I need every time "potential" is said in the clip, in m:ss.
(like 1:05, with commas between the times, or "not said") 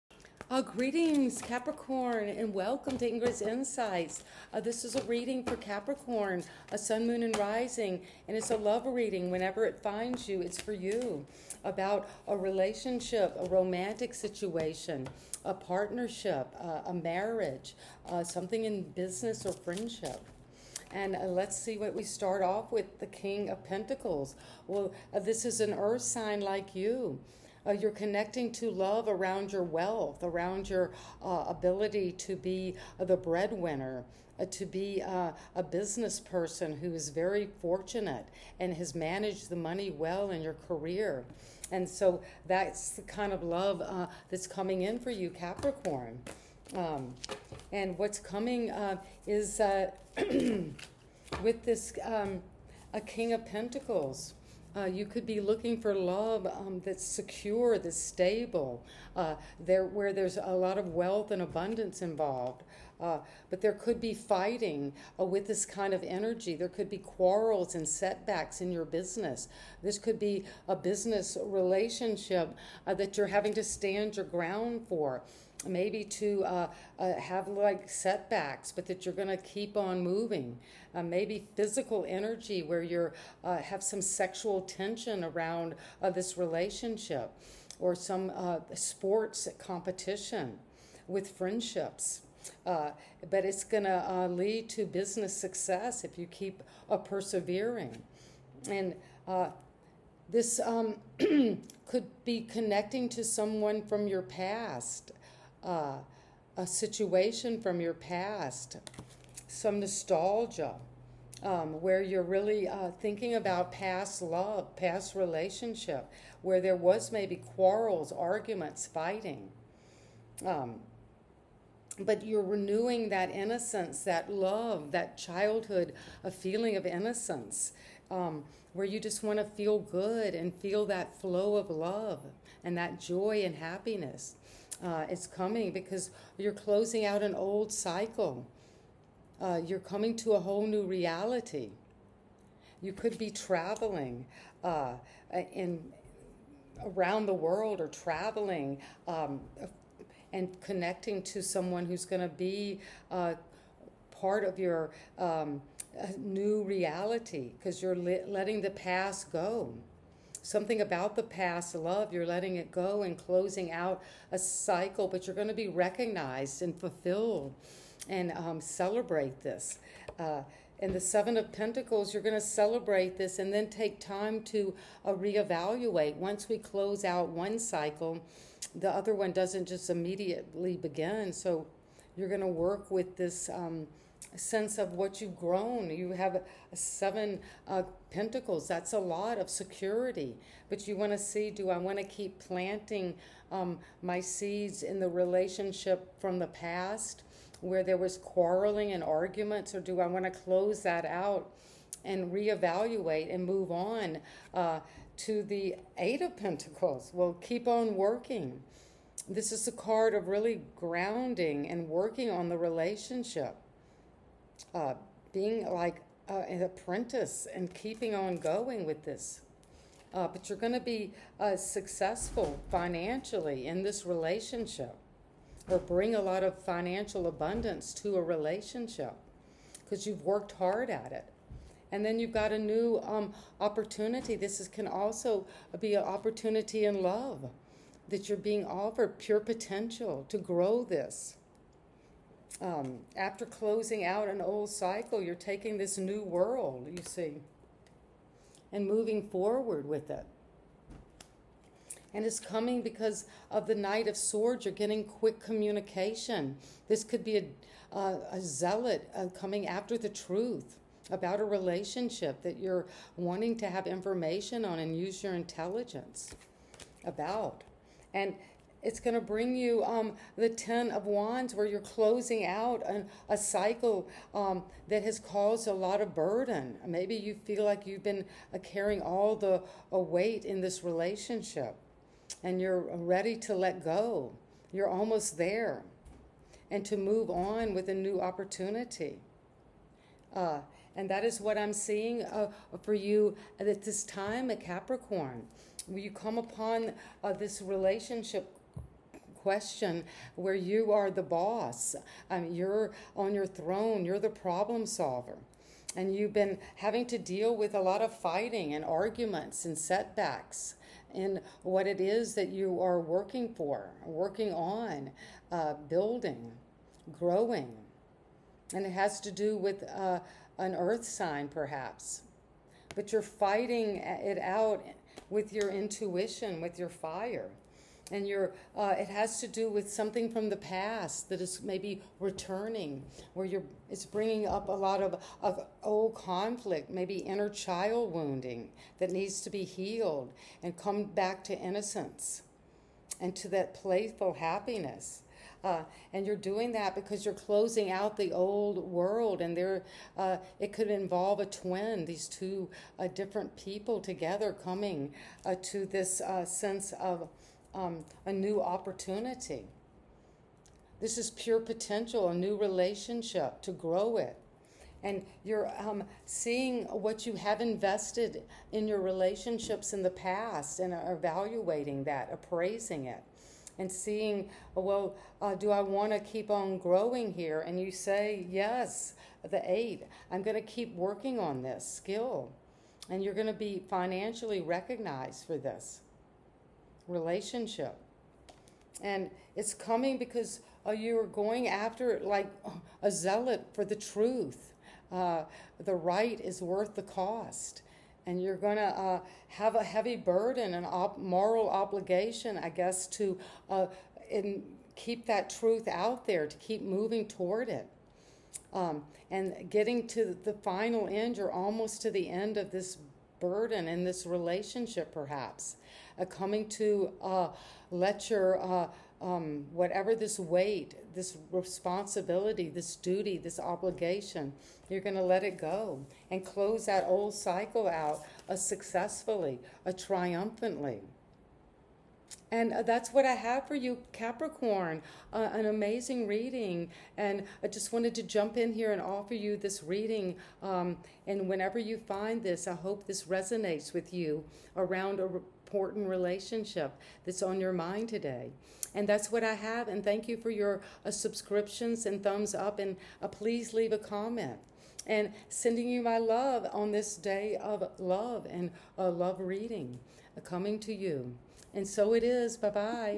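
3:59, 6:01.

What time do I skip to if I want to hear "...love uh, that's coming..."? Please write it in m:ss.
0:43.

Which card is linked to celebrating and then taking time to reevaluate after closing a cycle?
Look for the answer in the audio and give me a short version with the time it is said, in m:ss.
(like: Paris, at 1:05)
Seven of Pentacles, at 2:50.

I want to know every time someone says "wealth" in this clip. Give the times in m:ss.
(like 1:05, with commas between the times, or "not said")
0:29, 1:00.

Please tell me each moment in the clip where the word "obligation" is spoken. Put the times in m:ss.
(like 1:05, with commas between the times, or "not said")
6:41, 7:03.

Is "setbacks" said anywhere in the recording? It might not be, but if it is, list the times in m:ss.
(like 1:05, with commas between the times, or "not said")
1:07, 1:17, 5:09.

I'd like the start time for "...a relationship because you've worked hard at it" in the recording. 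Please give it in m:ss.
3:48.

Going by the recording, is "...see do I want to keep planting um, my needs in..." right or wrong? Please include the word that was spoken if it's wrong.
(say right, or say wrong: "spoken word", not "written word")
wrong: "seeds", not "needs".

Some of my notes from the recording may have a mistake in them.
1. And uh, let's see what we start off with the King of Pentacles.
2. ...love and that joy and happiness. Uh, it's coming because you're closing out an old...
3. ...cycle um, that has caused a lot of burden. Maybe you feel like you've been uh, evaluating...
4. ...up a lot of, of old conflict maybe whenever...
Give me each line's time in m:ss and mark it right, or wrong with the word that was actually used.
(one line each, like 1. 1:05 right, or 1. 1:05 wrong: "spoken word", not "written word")
1. 0:20 right
2. 2:11 right
3. 4:33 wrong: "carrying", not "evaluating"
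4. 5:34 wrong: "inner", not "whenever".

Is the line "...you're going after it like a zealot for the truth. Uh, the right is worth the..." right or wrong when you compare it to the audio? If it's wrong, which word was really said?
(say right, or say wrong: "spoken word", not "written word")
right.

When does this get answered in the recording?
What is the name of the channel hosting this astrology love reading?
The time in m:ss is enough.
0:03.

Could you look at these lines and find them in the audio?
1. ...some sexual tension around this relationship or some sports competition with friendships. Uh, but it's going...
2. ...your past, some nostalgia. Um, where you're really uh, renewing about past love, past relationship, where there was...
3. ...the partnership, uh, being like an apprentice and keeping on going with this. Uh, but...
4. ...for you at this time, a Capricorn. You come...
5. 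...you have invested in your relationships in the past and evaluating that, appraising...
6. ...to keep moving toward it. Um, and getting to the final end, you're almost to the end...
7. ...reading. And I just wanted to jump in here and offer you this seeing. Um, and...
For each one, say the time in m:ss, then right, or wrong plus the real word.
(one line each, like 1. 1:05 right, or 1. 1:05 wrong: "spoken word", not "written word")
1. 1:23 right
2. 1:47 wrong: "thinking", not "renewing"
3. 3:32 wrong: "relationship", not "partnership"
4. 4:52 right
5. 6:07 right
6. 6:46 right
7. 7:16 wrong: "reading", not "seeing".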